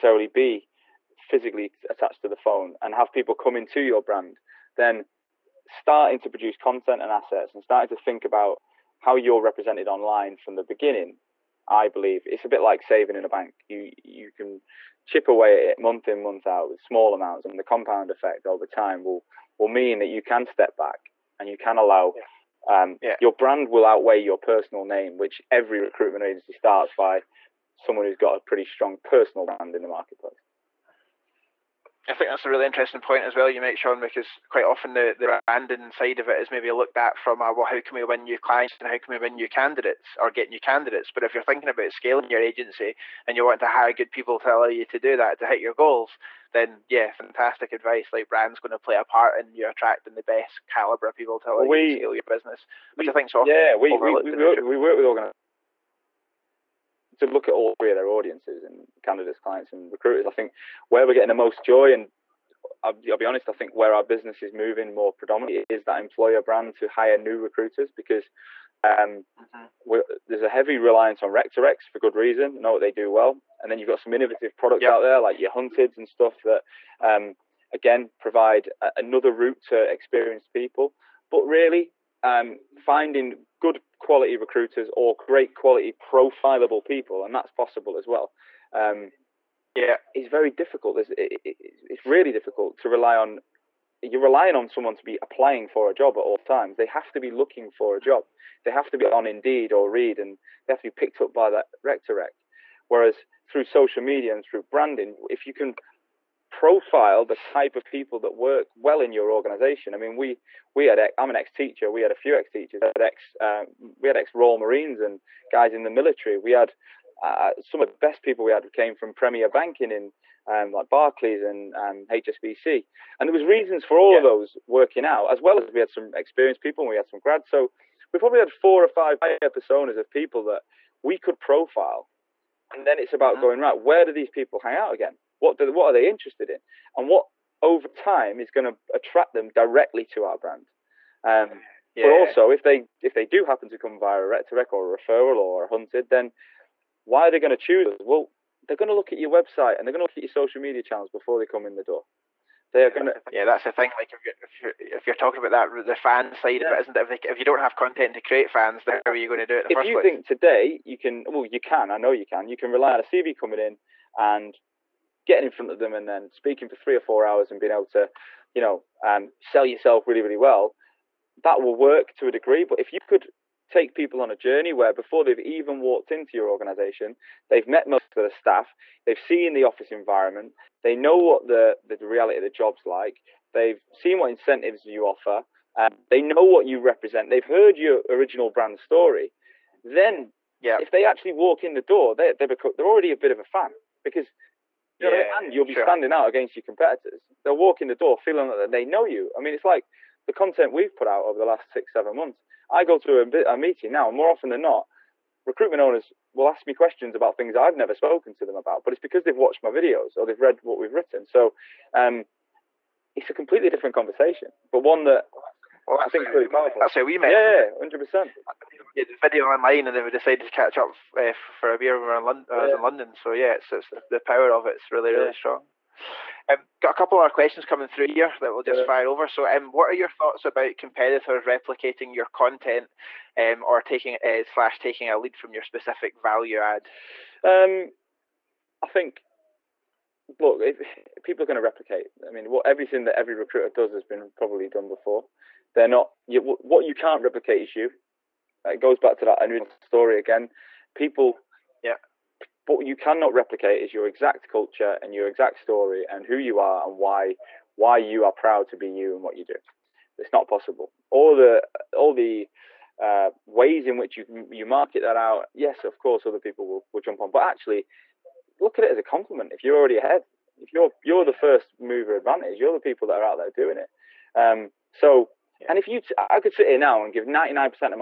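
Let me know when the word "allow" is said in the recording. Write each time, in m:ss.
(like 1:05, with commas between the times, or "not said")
0:21, 0:44, 0:51.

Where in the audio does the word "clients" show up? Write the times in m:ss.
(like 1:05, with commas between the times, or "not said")
0:38, 0:59.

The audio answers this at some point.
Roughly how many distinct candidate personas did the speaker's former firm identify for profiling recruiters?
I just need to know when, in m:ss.
2:08.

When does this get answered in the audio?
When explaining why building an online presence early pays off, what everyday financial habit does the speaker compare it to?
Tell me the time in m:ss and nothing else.
0:12.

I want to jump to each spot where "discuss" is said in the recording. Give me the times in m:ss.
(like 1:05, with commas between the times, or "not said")
not said.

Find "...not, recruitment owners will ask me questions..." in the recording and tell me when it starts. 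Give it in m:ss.
3:24.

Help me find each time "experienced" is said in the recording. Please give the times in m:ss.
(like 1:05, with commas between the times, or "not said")
1:19, 2:06.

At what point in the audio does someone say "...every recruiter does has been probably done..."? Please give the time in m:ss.
4:03.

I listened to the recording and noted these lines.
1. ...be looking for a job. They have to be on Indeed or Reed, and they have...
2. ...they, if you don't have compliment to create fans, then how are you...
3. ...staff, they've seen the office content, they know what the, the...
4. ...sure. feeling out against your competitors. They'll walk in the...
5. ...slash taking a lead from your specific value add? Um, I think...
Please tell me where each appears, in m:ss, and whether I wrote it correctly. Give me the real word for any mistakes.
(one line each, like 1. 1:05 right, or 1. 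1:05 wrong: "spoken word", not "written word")
1. 1:37 right
2. 2:37 wrong: "content", not "compliment"
3. 2:58 wrong: "environment", not "content"
4. 3:15 wrong: "standing", not "feeling"
5. 3:54 right.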